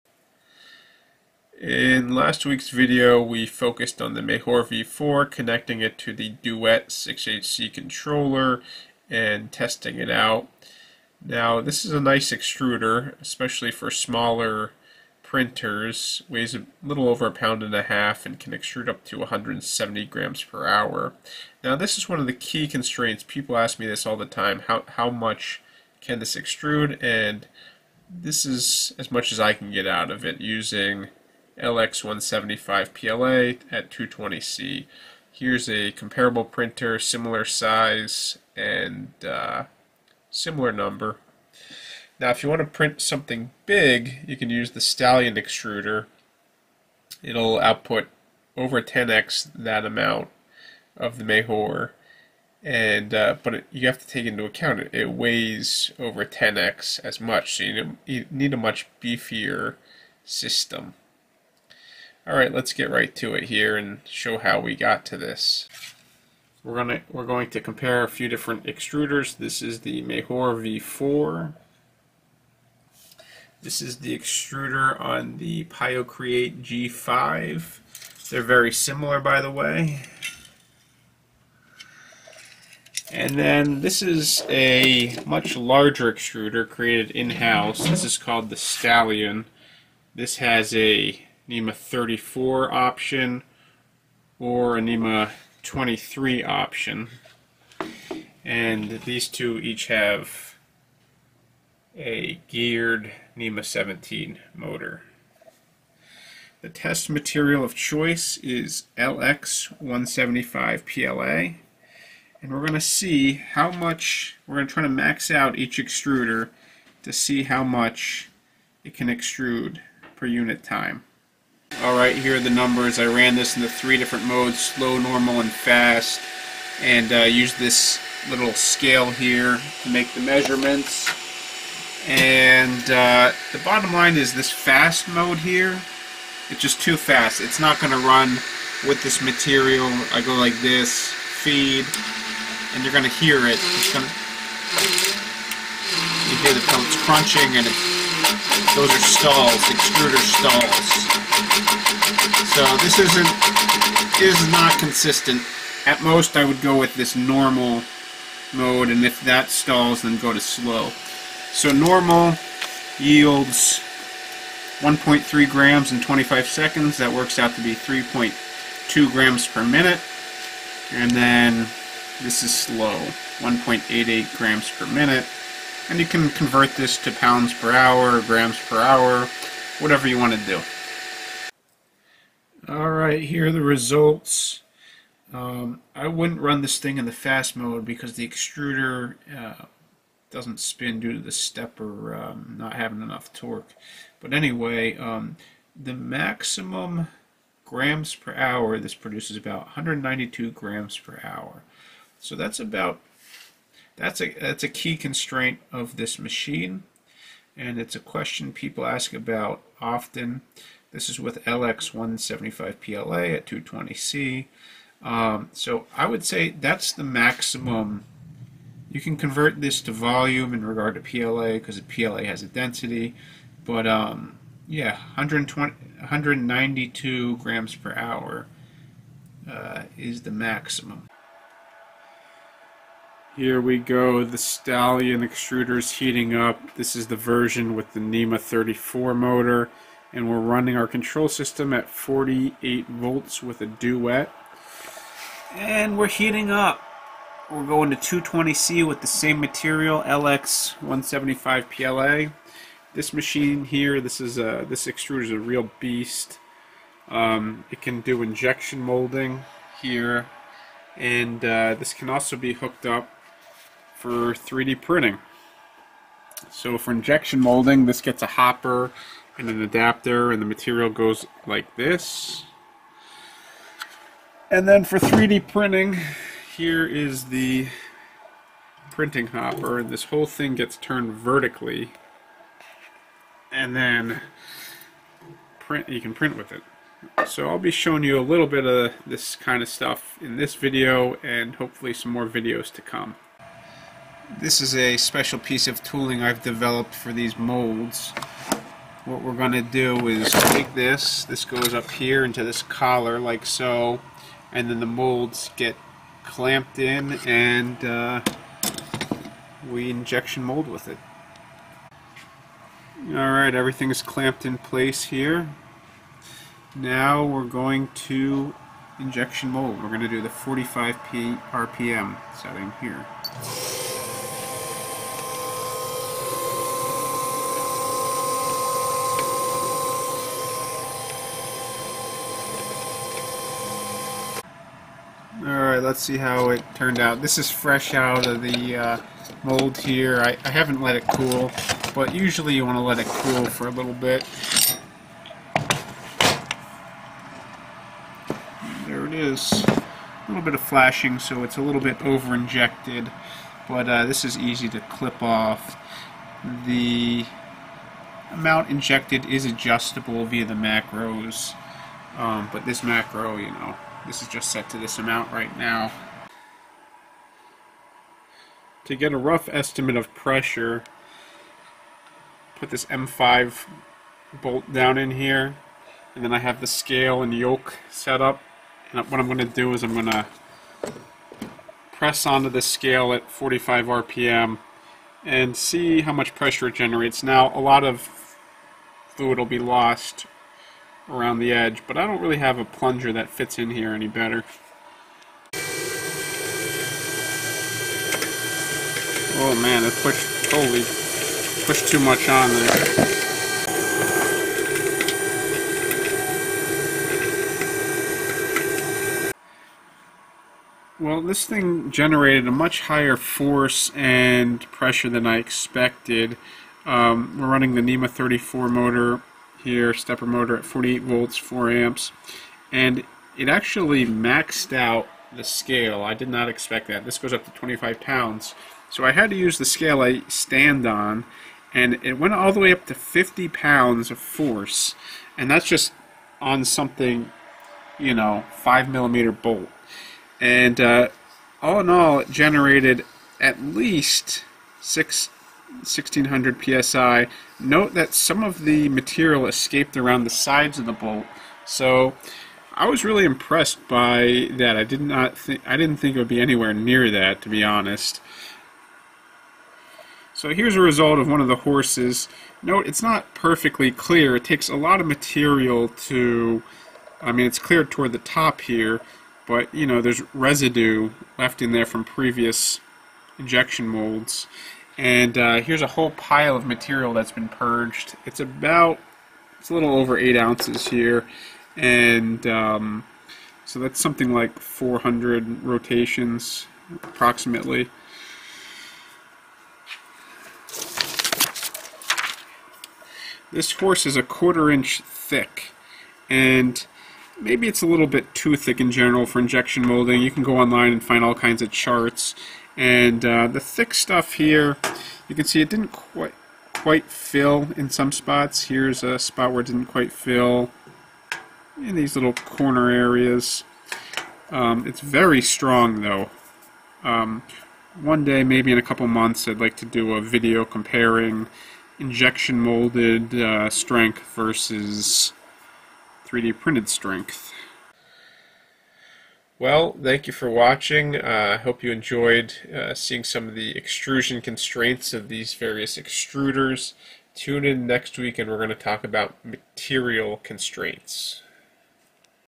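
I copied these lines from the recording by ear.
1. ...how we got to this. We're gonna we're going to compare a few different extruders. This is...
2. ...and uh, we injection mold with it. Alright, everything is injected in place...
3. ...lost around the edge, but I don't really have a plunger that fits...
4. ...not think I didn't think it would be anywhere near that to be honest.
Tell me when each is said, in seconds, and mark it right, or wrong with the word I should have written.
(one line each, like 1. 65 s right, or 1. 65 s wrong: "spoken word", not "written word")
1. 64 s right
2. 307 s wrong: "clamped", not "injected"
3. 389 s right
4. 455 s right.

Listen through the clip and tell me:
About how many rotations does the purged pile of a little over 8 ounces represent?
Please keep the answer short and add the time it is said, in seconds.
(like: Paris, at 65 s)
400, at 484 s.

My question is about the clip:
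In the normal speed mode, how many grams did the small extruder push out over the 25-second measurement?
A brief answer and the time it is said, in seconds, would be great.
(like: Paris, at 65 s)
1.3 grams, at 164 s.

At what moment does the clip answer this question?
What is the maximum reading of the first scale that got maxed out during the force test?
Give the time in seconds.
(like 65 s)
427 s.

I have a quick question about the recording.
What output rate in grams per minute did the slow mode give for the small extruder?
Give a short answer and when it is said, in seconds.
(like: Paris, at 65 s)
1.88, at 173 s.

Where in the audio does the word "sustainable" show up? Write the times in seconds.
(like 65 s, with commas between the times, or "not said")
not said.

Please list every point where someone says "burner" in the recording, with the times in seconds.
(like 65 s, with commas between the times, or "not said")
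not said.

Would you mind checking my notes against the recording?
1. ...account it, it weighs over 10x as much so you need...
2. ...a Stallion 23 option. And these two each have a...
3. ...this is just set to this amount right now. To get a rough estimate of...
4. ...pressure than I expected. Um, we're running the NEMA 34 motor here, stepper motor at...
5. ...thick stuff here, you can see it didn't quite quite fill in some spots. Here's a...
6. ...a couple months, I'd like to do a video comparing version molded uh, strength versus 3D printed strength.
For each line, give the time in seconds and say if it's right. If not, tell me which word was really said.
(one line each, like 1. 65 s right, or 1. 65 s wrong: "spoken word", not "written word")
1. 54 s right
2. 94 s wrong: "NEMA", not "Stallion"
3. 364 s right
4. 414 s right
5. 503 s right
6. 518 s wrong: "injection", not "version".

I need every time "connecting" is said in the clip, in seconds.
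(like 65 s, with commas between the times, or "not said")
5 s.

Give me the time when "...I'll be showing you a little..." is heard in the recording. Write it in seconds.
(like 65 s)
287 s.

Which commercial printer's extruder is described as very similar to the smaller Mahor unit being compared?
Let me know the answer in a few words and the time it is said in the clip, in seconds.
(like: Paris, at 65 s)
Piocreat G5, at 75 s.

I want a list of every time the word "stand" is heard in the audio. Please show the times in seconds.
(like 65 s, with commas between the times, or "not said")
430 s.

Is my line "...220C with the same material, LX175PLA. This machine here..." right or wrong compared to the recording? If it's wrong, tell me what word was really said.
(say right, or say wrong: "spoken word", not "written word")
right.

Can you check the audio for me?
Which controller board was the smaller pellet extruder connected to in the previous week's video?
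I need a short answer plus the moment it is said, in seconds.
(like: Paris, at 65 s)
Duet 6HC, at 6 s.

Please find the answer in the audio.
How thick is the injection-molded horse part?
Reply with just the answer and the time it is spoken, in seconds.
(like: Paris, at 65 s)
a quarter inch, at 494 s.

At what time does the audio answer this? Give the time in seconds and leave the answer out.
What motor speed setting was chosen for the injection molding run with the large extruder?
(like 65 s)
320 s.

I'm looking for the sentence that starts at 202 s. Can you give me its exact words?
So that's about that's a, that's a key constraint of this machine, and it's a question people ask about often.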